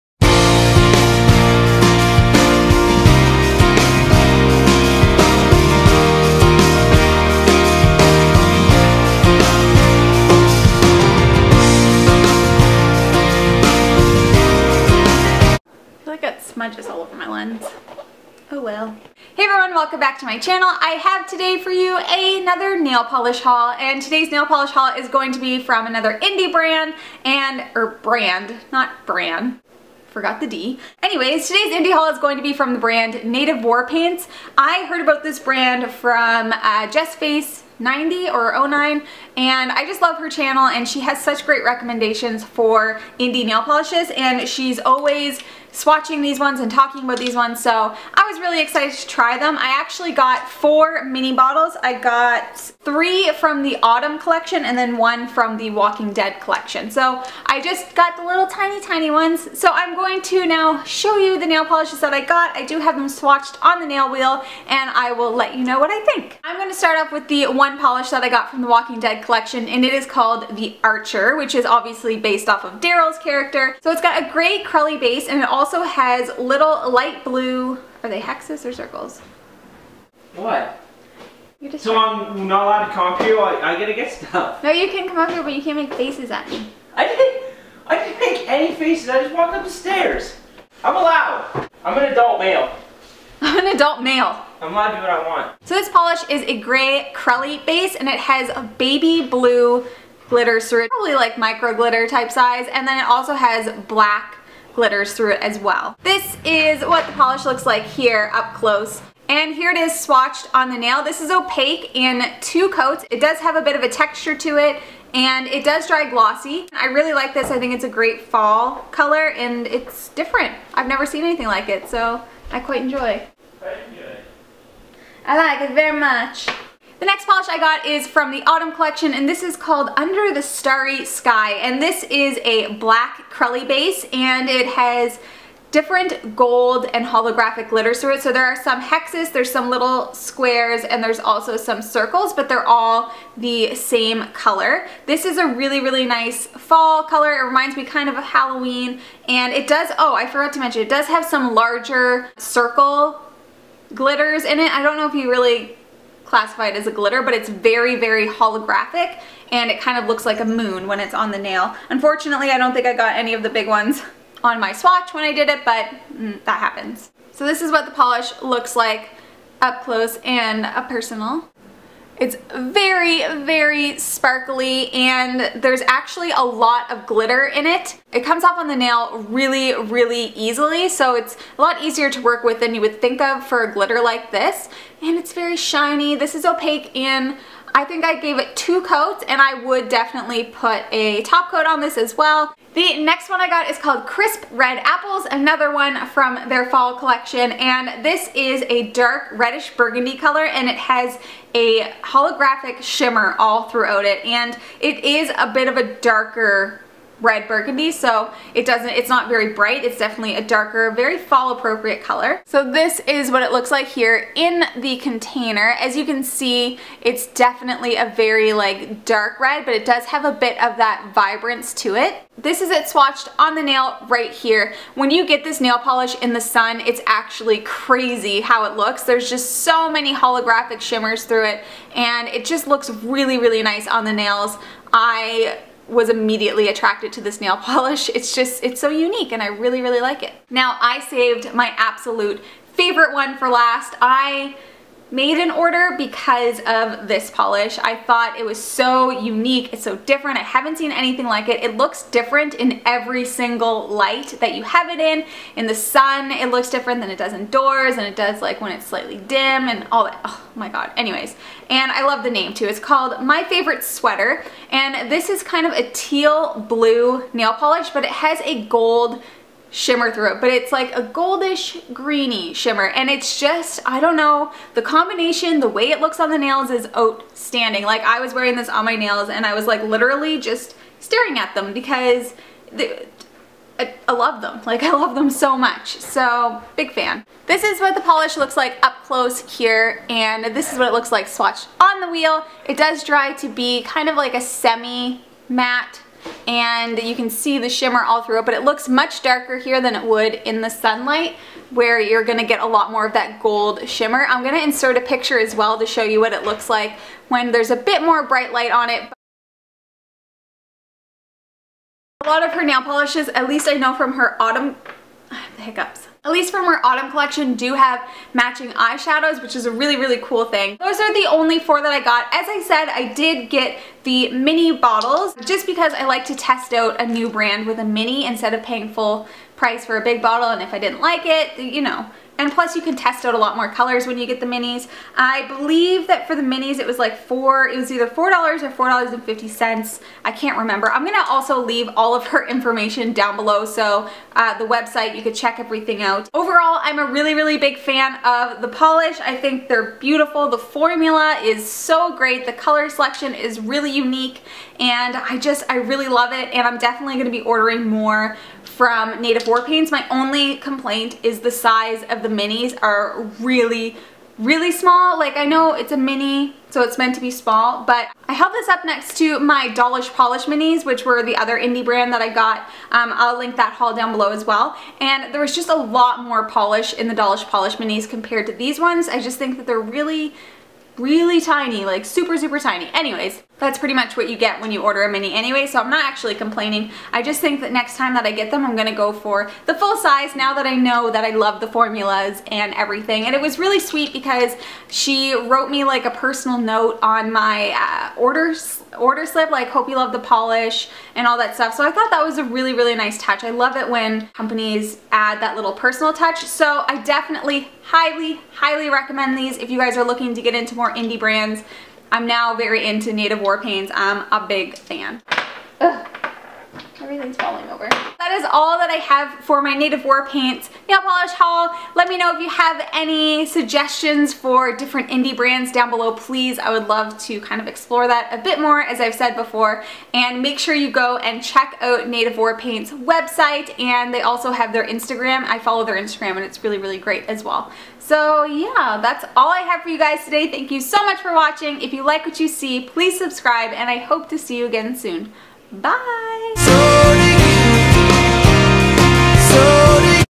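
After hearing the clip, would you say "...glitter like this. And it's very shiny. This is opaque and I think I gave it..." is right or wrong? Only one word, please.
right.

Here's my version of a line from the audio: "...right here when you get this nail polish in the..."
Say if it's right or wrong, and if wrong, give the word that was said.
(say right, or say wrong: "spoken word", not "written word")
right.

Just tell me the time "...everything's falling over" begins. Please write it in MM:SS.
06:57.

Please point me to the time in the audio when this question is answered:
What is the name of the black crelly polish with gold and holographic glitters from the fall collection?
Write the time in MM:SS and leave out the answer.
02:09.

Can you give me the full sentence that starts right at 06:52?
I'm now very into Native War Paints.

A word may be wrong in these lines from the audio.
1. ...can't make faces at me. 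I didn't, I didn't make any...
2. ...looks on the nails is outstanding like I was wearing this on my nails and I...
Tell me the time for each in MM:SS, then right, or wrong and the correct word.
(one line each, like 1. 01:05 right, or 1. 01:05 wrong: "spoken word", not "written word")
1. 01:25 right
2. 04:36 right.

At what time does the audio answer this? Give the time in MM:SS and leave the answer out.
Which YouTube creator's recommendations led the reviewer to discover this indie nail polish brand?
00:36.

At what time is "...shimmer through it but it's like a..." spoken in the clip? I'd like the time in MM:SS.
04:29.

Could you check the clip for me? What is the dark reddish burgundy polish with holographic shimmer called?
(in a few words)
Crisp Red Apples.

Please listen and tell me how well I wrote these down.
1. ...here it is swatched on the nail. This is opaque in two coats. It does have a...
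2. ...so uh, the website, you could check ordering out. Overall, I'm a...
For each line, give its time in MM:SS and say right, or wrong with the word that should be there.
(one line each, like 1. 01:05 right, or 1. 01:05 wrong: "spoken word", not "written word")
1. 01:49 right
2. 05:43 wrong: "everything", not "ordering".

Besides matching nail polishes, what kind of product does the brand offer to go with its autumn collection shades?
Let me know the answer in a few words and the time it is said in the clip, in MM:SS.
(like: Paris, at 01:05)
eyeshadows, at 05:18.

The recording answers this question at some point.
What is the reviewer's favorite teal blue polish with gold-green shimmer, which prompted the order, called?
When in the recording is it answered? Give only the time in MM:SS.
04:23.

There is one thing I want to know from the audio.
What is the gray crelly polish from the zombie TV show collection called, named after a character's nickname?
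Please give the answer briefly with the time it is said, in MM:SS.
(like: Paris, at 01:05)
The Archer, at 01:10.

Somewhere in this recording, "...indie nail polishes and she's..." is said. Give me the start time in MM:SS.
00:43.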